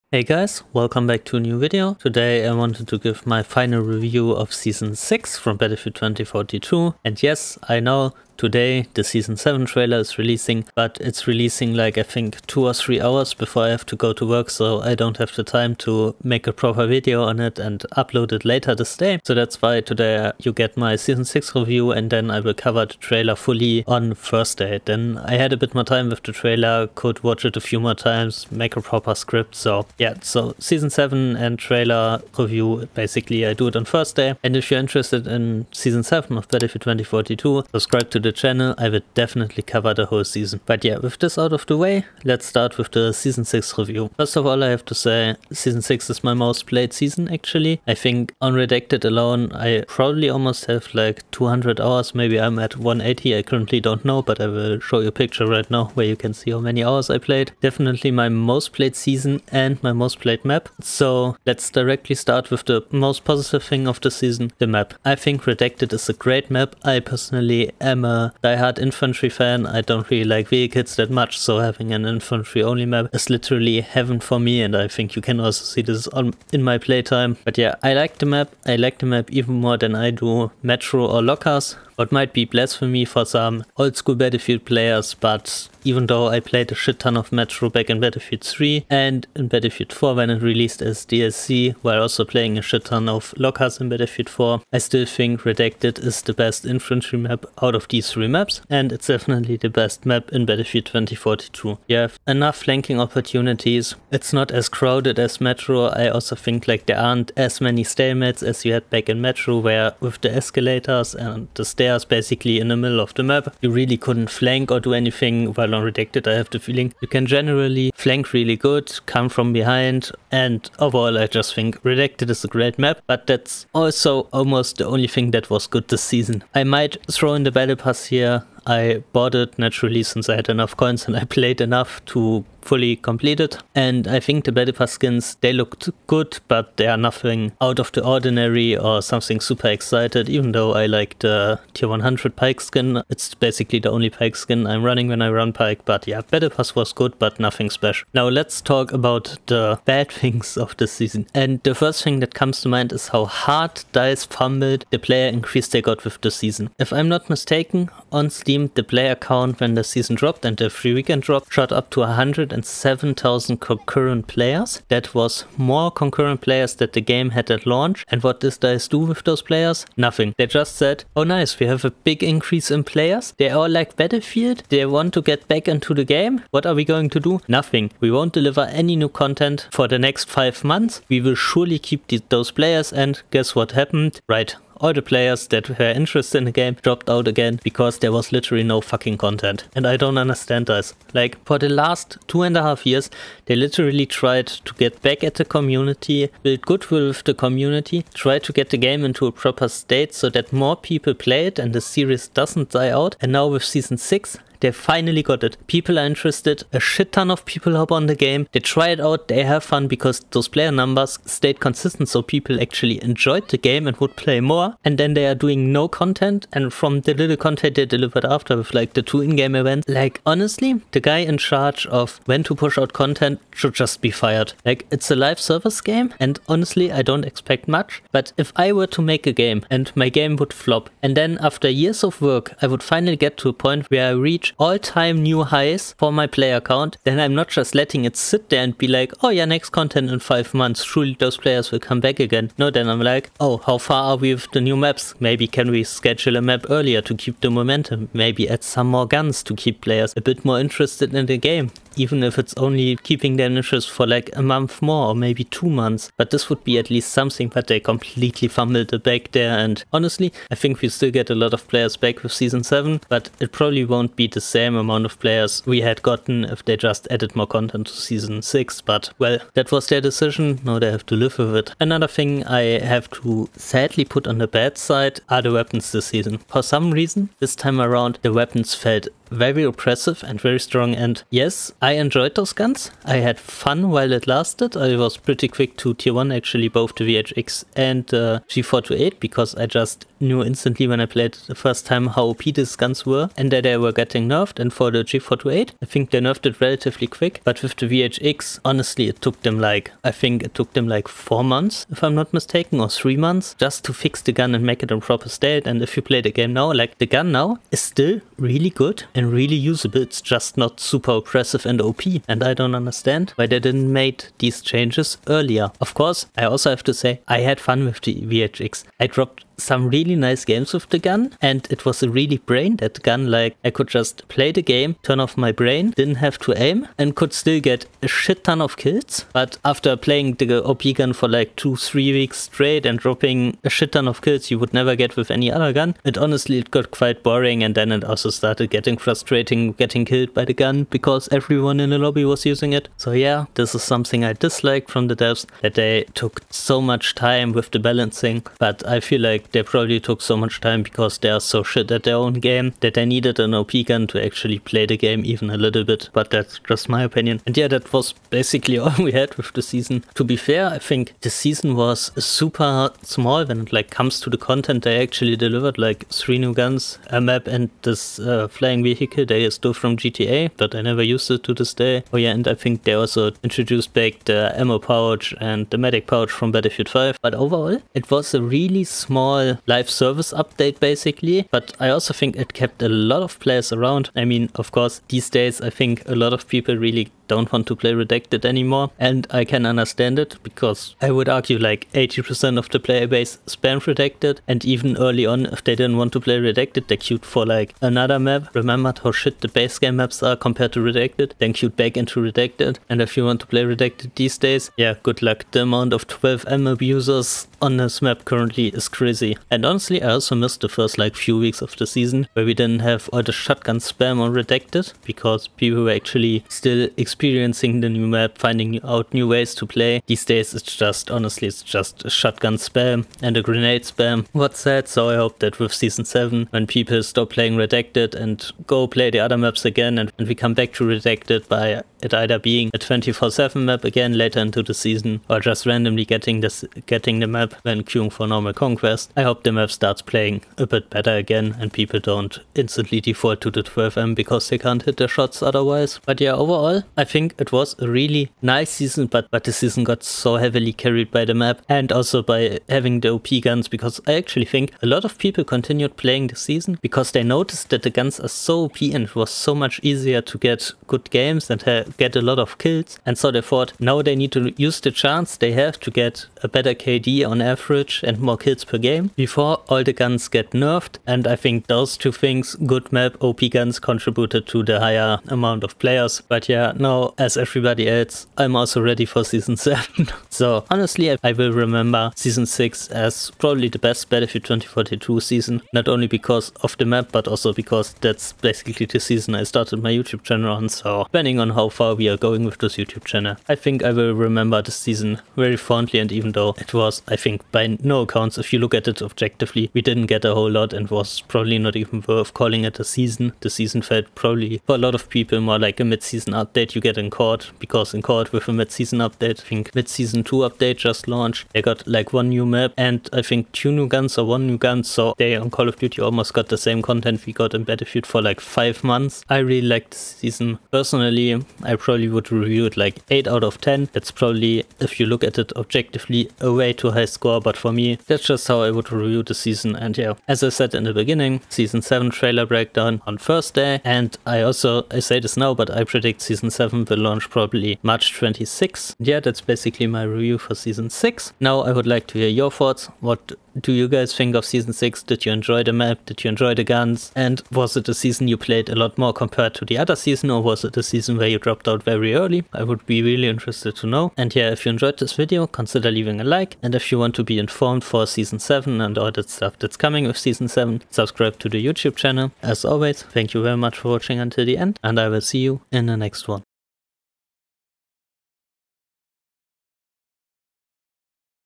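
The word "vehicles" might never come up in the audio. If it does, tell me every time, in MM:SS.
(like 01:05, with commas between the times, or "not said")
01:10, 06:08.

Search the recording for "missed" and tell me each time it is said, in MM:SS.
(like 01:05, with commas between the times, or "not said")
06:50.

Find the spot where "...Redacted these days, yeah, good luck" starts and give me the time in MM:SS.
06:43.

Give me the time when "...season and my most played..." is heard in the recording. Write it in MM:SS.
00:58.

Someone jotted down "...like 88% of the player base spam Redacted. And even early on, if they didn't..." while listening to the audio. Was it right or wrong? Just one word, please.
wrong.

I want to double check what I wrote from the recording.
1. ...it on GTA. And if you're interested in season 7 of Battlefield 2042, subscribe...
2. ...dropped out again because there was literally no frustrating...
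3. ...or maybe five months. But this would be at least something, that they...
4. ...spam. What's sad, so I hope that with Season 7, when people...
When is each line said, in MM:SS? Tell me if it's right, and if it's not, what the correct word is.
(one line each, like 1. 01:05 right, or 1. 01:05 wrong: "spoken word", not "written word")
1. 00:33 wrong: "Thursday", not "GTA"
2. 03:06 wrong: "fucking", not "frustrating"
3. 04:15 wrong: "two", not "five"
4. 07:03 right.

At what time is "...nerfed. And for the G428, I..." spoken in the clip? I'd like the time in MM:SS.
04:54.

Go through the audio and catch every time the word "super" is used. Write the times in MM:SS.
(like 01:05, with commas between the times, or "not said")
02:19, 05:10, 06:02.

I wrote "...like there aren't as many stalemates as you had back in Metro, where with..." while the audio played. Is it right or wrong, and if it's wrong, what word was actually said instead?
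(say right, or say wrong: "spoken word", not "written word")
right.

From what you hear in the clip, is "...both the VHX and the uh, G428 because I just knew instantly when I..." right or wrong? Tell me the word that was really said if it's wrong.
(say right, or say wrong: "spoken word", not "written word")
right.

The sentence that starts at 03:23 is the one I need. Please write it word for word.
And now with season 6, they finally got it.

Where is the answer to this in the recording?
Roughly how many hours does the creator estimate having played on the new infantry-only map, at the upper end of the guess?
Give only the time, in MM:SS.
00:51.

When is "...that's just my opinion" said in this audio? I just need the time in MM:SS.
05:56.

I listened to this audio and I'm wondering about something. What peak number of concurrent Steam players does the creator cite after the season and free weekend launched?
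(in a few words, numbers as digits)
107,000.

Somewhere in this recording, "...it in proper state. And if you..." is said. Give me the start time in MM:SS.
05:04.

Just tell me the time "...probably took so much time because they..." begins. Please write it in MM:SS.
05:49.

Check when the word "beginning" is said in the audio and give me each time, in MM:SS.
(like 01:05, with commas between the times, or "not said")
08:50.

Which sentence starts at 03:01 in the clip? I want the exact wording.
We will surely keep those players.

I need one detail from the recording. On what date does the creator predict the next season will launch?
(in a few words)
March 26.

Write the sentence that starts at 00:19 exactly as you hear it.
So that's why today you get my season 6 review and then I will cover the trailer fully on Thursday.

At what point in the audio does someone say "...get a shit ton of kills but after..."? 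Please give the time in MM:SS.
05:27.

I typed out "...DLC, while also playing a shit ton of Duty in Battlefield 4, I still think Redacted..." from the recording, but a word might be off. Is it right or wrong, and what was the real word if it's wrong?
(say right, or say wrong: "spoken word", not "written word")
wrong: "Lockharts", not "Duty".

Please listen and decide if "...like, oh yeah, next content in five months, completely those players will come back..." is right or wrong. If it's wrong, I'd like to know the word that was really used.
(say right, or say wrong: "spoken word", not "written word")
wrong: "surely", not "completely".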